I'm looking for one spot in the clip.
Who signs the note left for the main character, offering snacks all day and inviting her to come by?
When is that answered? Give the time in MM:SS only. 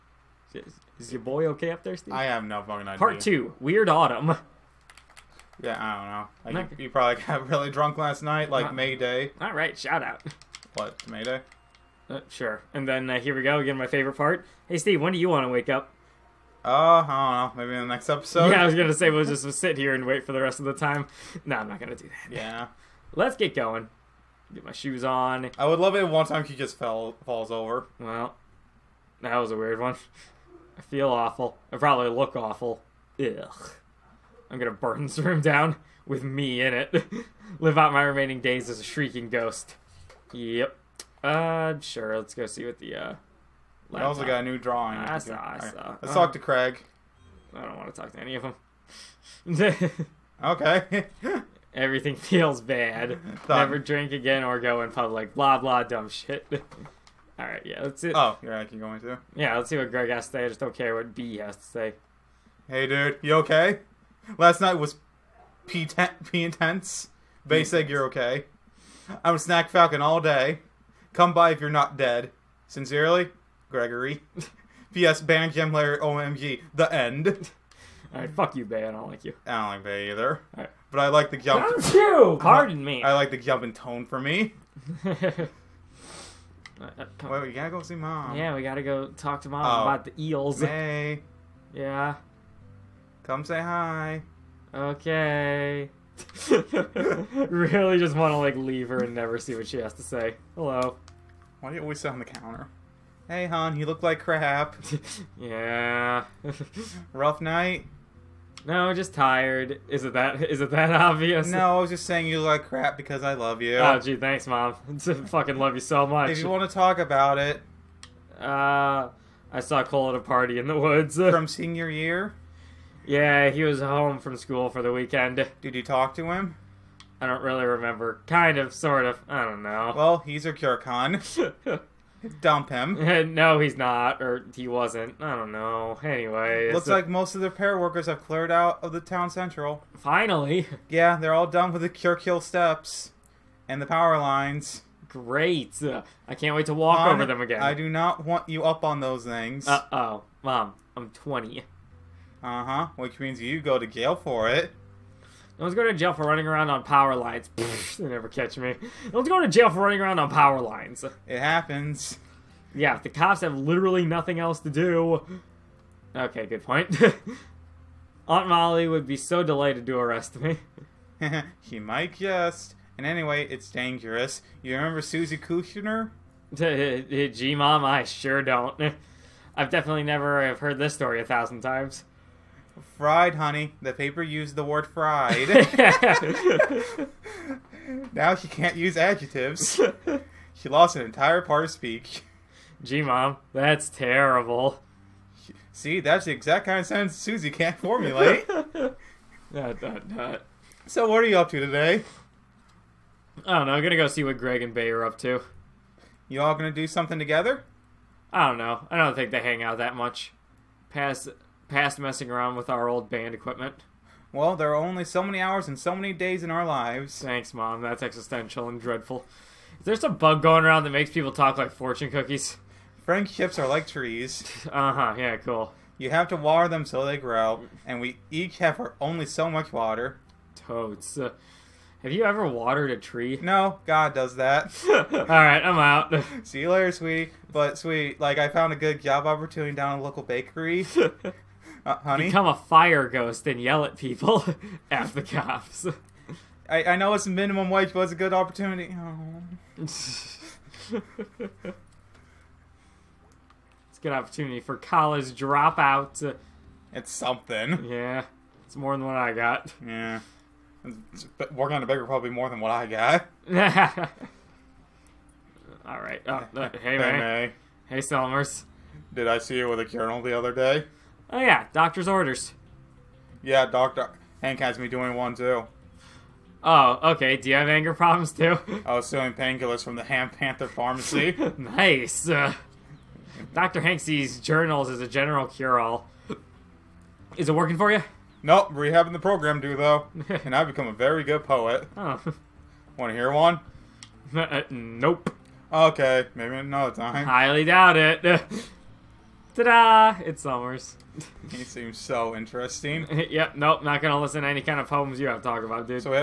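01:13.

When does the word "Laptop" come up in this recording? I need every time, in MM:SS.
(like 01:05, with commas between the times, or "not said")
00:43.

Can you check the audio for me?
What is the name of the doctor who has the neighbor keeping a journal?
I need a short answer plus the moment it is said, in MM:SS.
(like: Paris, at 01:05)
Dr. Hank, at 04:33.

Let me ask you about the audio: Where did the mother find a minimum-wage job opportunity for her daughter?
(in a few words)
a local bakery.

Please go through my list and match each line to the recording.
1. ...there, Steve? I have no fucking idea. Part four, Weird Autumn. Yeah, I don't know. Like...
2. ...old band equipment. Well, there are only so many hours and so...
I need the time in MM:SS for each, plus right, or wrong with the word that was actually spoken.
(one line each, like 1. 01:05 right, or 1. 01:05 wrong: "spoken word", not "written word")
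1. 00:01 wrong: "two", not "four"
2. 03:32 right.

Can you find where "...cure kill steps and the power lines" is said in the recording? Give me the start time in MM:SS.
02:21.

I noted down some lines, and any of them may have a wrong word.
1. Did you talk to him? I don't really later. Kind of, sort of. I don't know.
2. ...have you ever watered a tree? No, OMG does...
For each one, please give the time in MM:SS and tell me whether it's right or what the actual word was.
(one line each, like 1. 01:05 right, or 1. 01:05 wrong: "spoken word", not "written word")
1. 02:05 wrong: "remember", not "later"
2. 03:52 wrong: "God", not "OMG".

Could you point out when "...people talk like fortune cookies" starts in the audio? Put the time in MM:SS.
03:41.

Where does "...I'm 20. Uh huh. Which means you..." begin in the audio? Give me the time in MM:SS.
02:30.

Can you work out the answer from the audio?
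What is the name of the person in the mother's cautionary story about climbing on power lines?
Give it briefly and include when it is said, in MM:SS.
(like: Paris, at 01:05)
Susie Kushner, at 02:55.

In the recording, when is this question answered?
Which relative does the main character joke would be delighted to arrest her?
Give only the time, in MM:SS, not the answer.
02:48.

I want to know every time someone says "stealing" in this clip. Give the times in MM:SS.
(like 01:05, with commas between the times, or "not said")
04:39.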